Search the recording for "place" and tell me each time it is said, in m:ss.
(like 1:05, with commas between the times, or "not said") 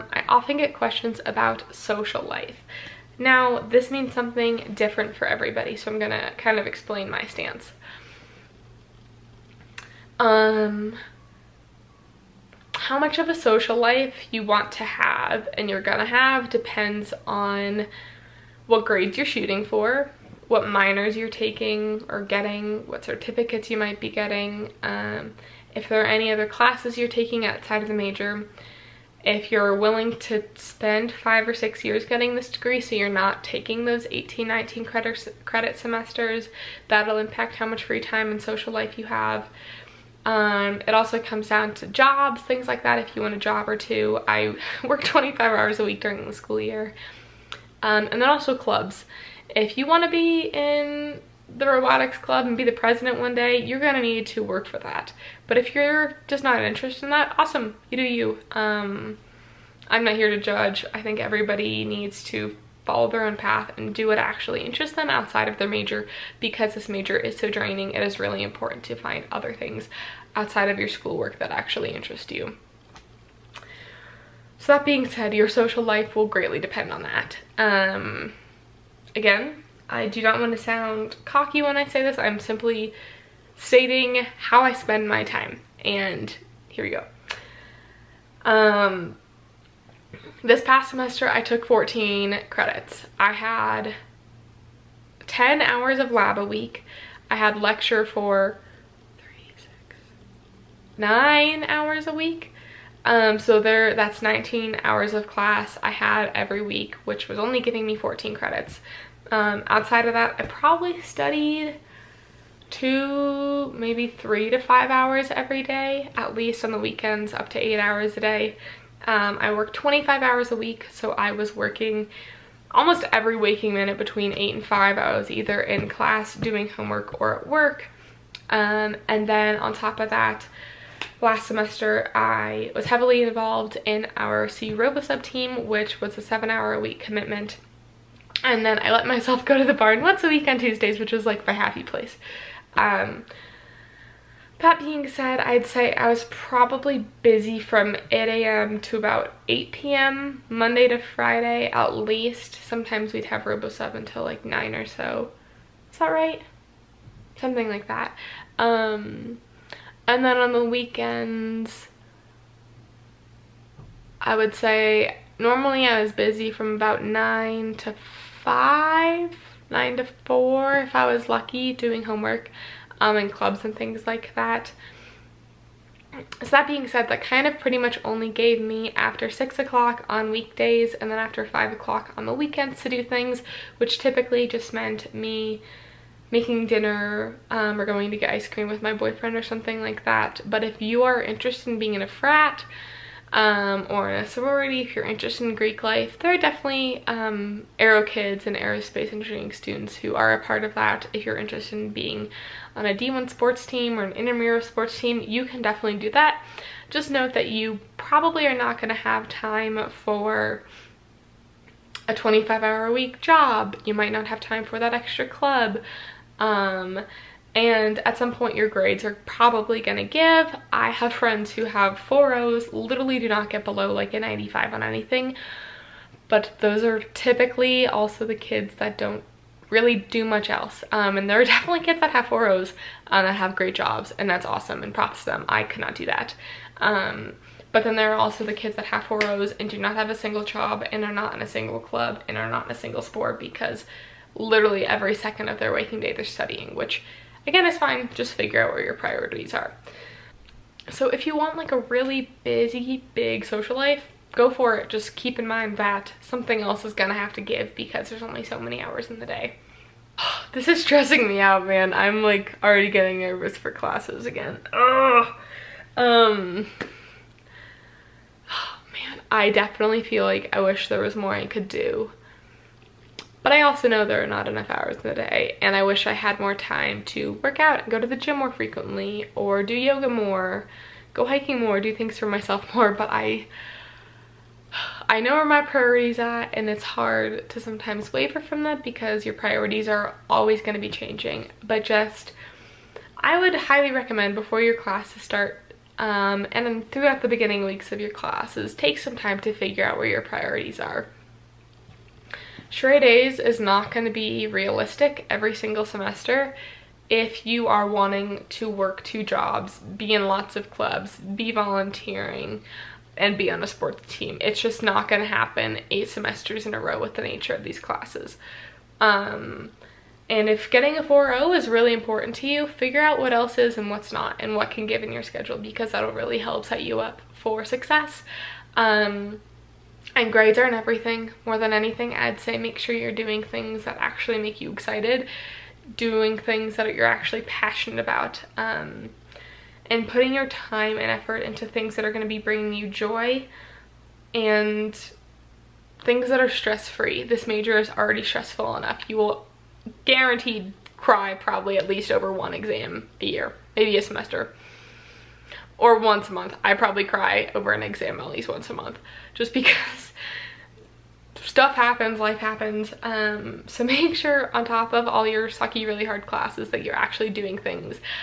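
2:21.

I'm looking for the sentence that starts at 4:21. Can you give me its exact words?
I'm like already getting nervous for classes again.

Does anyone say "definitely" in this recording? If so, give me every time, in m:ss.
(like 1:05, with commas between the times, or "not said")
3:16, 3:25, 3:51, 4:29.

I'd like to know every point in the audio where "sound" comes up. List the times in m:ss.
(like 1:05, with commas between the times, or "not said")
1:20.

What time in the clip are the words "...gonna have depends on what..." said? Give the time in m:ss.
0:15.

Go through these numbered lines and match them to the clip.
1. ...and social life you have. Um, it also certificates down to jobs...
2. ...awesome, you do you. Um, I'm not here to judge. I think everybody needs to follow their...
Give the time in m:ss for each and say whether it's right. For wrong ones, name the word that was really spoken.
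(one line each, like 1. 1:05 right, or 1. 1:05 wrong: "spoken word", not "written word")
1. 0:38 wrong: "comes", not "certificates"
2. 0:57 right.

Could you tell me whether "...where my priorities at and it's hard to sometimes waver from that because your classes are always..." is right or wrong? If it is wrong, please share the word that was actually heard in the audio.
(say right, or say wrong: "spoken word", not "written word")
wrong: "priorities", not "classes".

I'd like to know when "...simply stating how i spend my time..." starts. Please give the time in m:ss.
1:22.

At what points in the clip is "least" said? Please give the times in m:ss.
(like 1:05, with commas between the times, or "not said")
1:56, 2:31, 5:51, 5:58.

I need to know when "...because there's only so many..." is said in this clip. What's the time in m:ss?
4:17.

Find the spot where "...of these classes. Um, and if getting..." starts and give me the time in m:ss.
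5:17.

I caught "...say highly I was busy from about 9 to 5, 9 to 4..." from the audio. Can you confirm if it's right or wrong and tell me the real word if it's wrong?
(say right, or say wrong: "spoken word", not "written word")
wrong: "normally", not "highly".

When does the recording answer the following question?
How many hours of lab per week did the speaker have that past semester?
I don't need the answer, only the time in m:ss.
1:35.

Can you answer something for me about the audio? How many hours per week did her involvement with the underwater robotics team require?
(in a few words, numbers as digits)
7.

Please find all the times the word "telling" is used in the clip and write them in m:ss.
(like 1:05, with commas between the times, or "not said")
not said.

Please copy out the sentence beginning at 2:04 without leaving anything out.
I was either in class doing homework or at work.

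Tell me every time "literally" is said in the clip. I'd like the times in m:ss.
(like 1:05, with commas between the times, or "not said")
3:42, 4:04.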